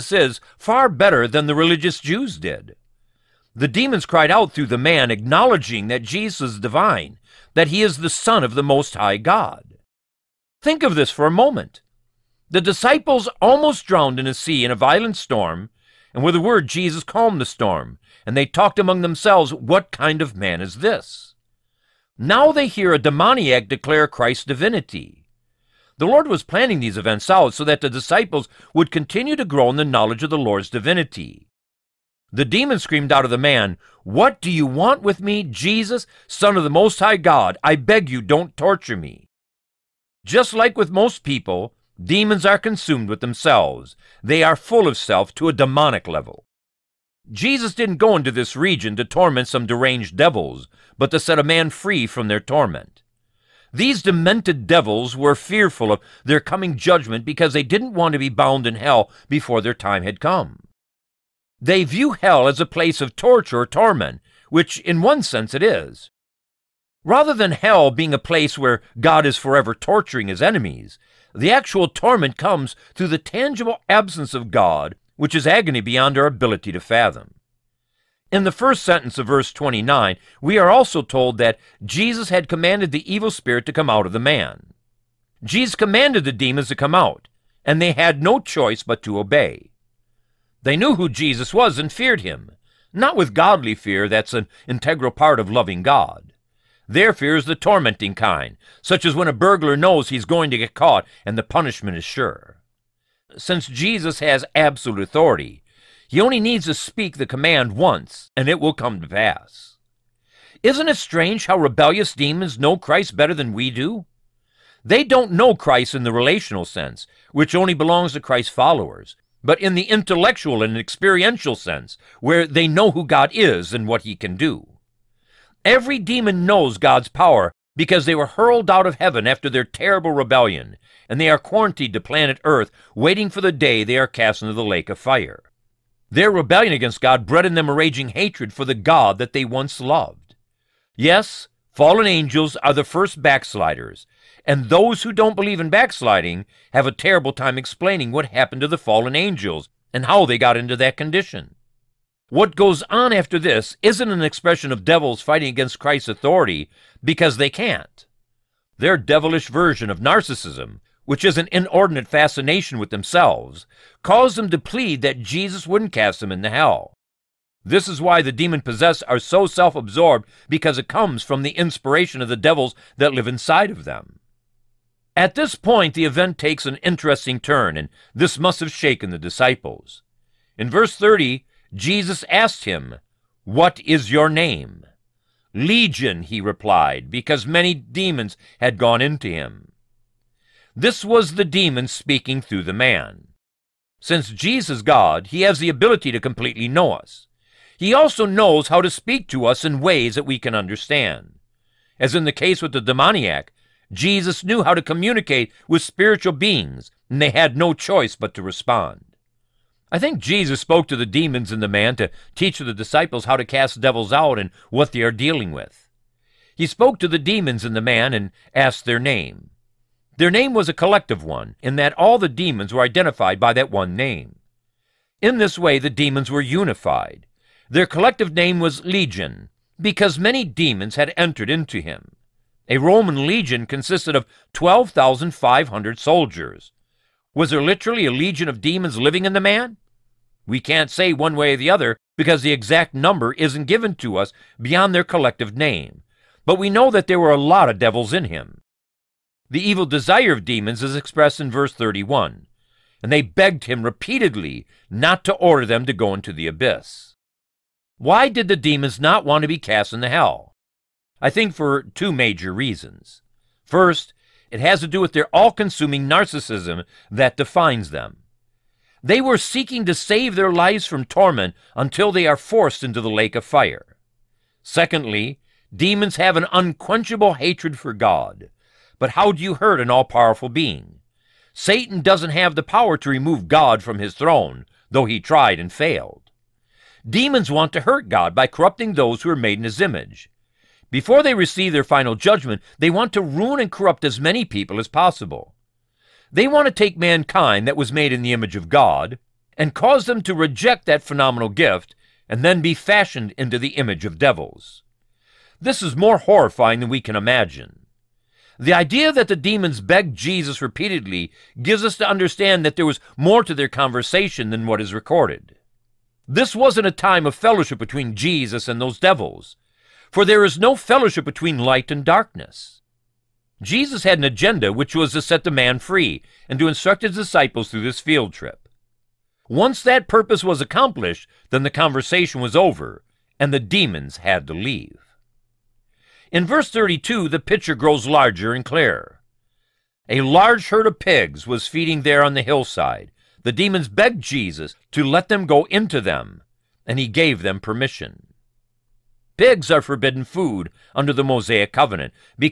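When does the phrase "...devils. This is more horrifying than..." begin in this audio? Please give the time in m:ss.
5:04.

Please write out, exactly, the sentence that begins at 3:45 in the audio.
In this way, the demons were unified.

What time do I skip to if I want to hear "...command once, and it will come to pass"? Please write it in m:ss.
1:47.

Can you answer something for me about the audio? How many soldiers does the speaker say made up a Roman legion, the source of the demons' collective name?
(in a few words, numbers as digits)
12,500.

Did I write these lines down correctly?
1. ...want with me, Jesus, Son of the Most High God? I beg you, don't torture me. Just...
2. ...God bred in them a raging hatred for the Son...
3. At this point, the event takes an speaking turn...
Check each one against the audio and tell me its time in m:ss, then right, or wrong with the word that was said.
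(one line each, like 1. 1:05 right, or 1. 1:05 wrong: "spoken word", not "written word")
1. 0:34 right
2. 2:17 wrong: "God", not "Son"
3. 2:55 wrong: "interesting", not "speaking".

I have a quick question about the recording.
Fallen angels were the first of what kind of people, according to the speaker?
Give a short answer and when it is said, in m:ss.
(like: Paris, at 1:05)
backsliders, at 2:23.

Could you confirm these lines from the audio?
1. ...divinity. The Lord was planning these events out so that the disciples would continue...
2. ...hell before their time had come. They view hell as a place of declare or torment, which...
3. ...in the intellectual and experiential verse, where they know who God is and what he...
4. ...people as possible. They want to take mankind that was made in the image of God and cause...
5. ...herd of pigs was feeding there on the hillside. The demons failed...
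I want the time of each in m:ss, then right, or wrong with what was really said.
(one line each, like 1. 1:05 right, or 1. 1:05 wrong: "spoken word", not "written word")
1. 0:24 right
2. 0:58 wrong: "torture", not "declare"
3. 1:59 wrong: "sense", not "verse"
4. 4:54 right
5. 5:40 wrong: "begged", not "failed".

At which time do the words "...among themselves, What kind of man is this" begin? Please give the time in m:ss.
0:18.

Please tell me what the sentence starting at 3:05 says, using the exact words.
Legion, he replied, because many demons had gone into him.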